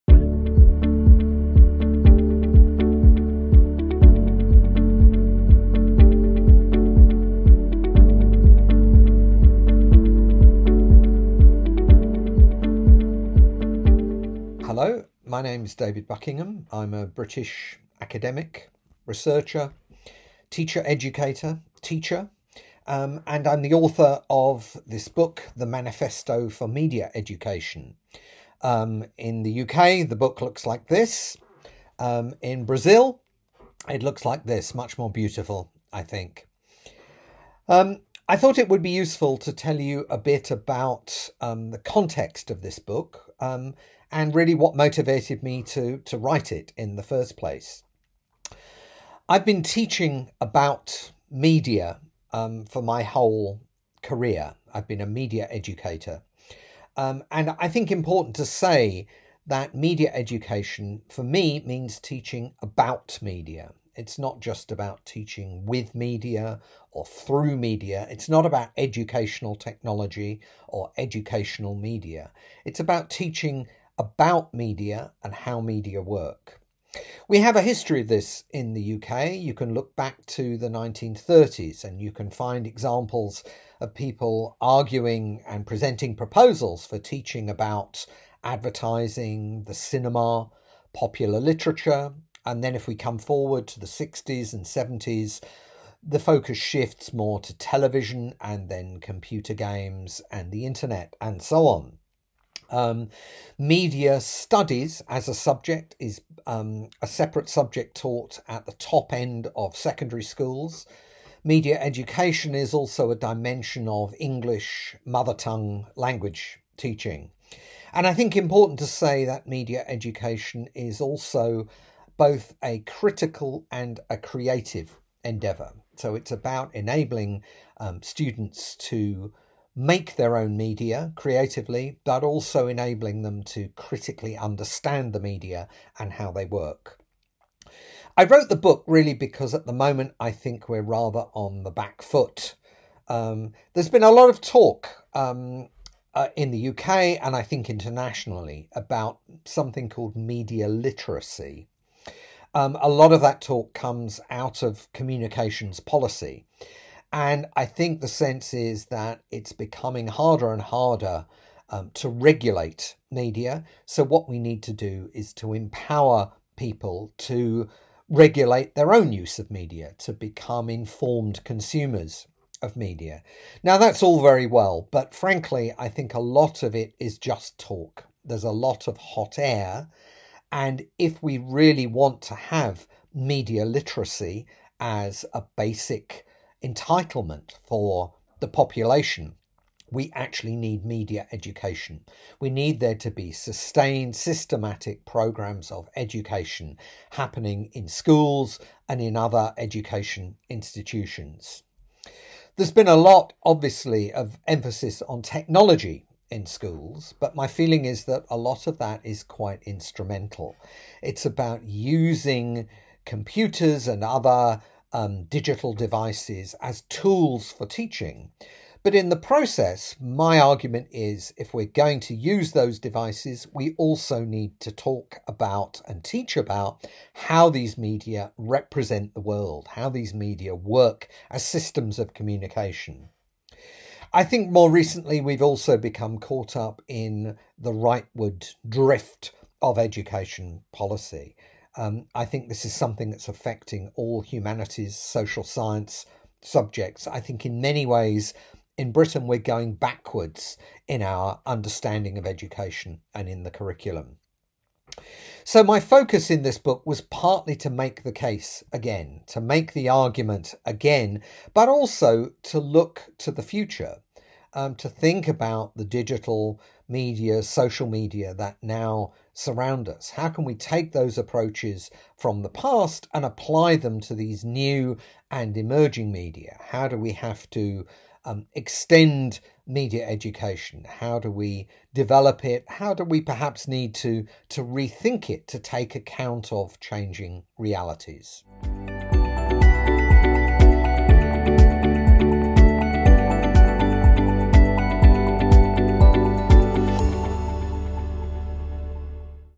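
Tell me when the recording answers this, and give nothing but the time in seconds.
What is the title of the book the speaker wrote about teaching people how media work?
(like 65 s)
25 s.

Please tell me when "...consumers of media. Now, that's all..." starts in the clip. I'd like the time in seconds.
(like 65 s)
171 s.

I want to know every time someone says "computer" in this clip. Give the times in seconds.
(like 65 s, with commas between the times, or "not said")
98 s, 213 s.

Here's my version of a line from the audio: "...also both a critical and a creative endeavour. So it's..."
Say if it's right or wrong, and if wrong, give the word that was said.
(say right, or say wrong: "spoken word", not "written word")
right.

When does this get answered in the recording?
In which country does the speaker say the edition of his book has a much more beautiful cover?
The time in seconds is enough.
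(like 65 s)
32 s.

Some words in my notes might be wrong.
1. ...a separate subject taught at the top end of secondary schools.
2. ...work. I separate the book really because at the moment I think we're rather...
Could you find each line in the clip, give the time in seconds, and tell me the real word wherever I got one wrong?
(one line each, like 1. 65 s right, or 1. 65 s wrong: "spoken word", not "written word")
1. 107 s right
2. 136 s wrong: "wrote", not "separate".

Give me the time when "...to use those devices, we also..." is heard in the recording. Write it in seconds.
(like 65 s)
222 s.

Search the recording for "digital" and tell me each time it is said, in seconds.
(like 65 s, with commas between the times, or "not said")
215 s, 265 s.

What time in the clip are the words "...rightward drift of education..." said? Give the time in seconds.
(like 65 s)
237 s.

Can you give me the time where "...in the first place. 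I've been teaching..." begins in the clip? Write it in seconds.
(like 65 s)
46 s.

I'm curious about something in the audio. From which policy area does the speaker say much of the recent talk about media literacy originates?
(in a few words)
communications policy.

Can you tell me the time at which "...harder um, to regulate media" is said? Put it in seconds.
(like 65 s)
160 s.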